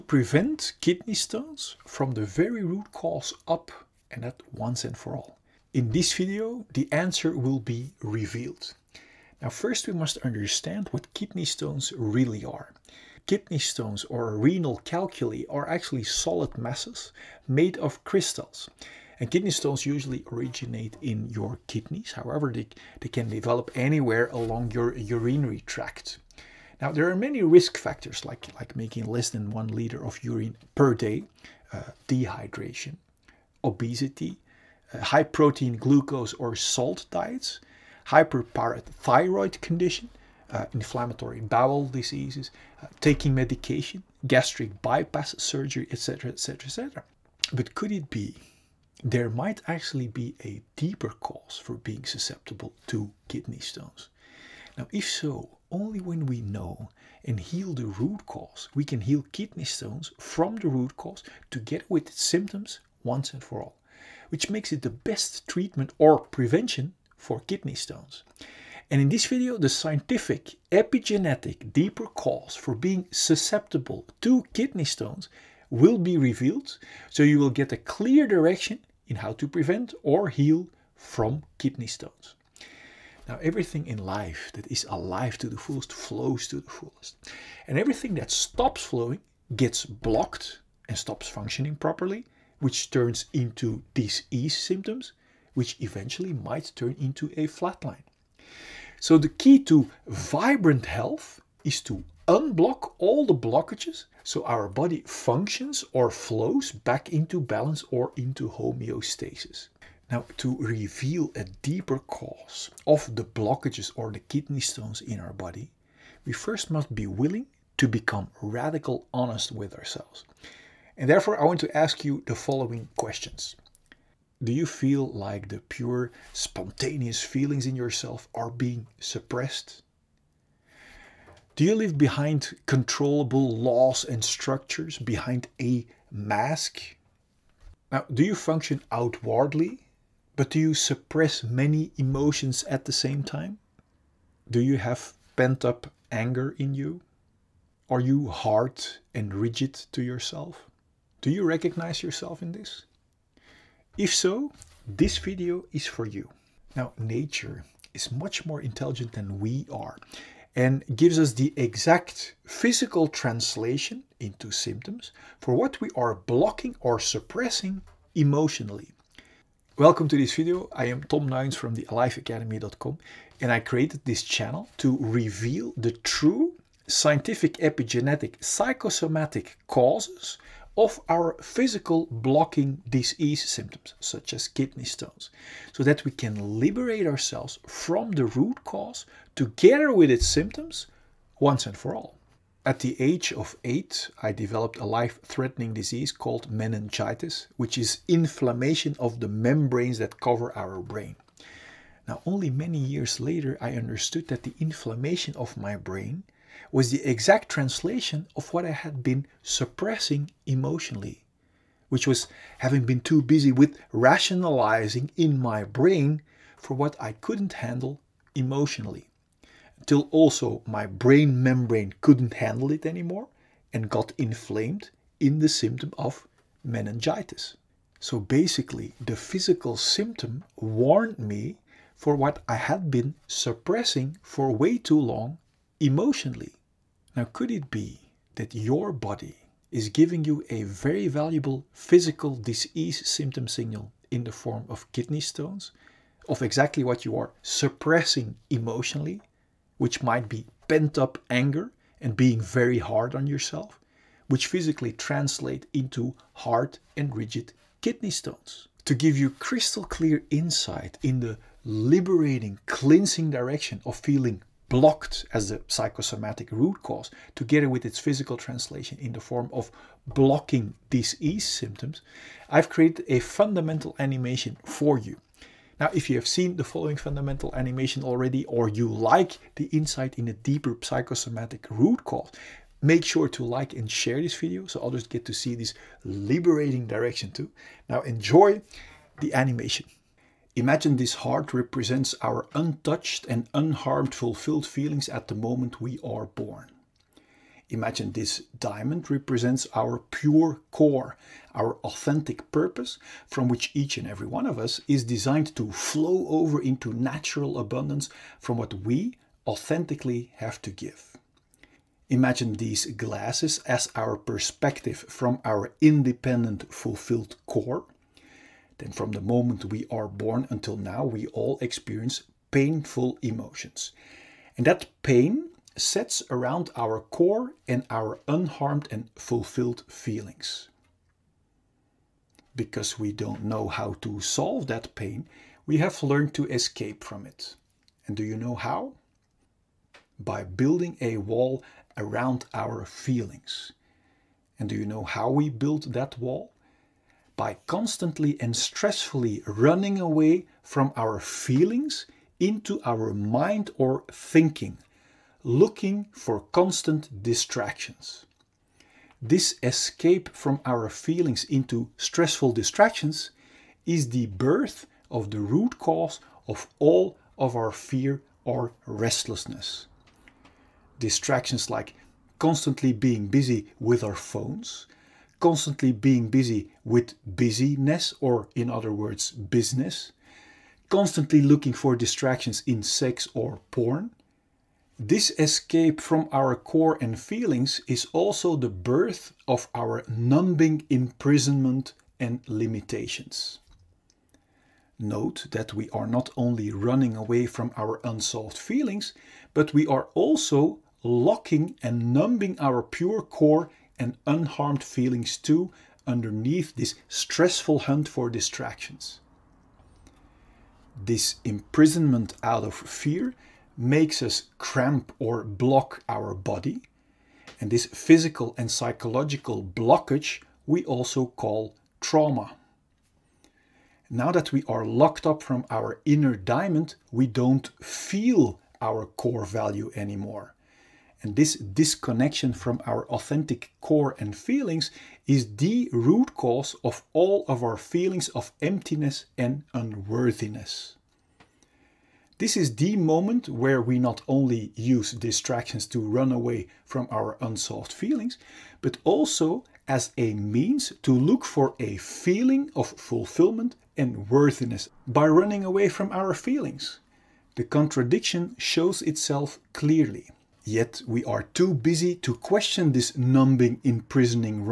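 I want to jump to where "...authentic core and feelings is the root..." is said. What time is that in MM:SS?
07:13.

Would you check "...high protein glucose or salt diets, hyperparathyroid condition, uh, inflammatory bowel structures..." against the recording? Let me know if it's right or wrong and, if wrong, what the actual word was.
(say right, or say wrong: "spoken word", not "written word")
wrong: "diseases", not "structures".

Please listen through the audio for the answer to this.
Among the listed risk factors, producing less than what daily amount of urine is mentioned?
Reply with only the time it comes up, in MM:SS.
00:29.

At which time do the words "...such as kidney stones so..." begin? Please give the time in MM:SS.
03:03.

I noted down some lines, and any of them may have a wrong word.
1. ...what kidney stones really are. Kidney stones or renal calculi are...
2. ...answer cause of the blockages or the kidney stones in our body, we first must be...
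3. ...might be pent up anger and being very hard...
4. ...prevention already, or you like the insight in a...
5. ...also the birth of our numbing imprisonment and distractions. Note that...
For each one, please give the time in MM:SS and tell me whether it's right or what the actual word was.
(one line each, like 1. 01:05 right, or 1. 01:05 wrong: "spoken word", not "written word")
1. 00:10 right
2. 01:51 wrong: "deeper", not "answer"
3. 04:10 right
4. 04:37 wrong: "animation", not "prevention"
5. 06:28 wrong: "limitations", not "distractions".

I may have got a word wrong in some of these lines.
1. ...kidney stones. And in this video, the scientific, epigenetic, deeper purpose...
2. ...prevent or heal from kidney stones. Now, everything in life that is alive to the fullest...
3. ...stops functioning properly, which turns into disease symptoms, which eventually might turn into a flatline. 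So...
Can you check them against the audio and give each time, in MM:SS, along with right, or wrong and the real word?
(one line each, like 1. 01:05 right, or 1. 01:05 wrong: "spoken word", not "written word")
1. 01:07 wrong: "cause", not "purpose"
2. 01:19 right
3. 01:30 right.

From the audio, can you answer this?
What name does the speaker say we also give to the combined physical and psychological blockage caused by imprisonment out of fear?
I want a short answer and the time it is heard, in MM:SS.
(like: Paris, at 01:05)
Trauma, at 07:01.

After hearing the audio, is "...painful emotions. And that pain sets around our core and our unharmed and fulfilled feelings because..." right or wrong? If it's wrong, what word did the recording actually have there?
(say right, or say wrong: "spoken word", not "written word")
right.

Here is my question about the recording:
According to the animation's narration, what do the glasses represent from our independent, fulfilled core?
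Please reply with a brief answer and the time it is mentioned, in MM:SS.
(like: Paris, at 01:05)
Our perspective, at 05:13.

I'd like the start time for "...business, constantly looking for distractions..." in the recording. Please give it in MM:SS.
06:19.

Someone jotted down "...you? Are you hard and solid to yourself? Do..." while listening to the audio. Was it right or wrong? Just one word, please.
wrong.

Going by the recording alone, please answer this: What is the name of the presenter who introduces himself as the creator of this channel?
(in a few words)
Tom Nines.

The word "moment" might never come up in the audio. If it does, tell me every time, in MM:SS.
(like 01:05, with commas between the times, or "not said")
04:55, 05:19, 07:22.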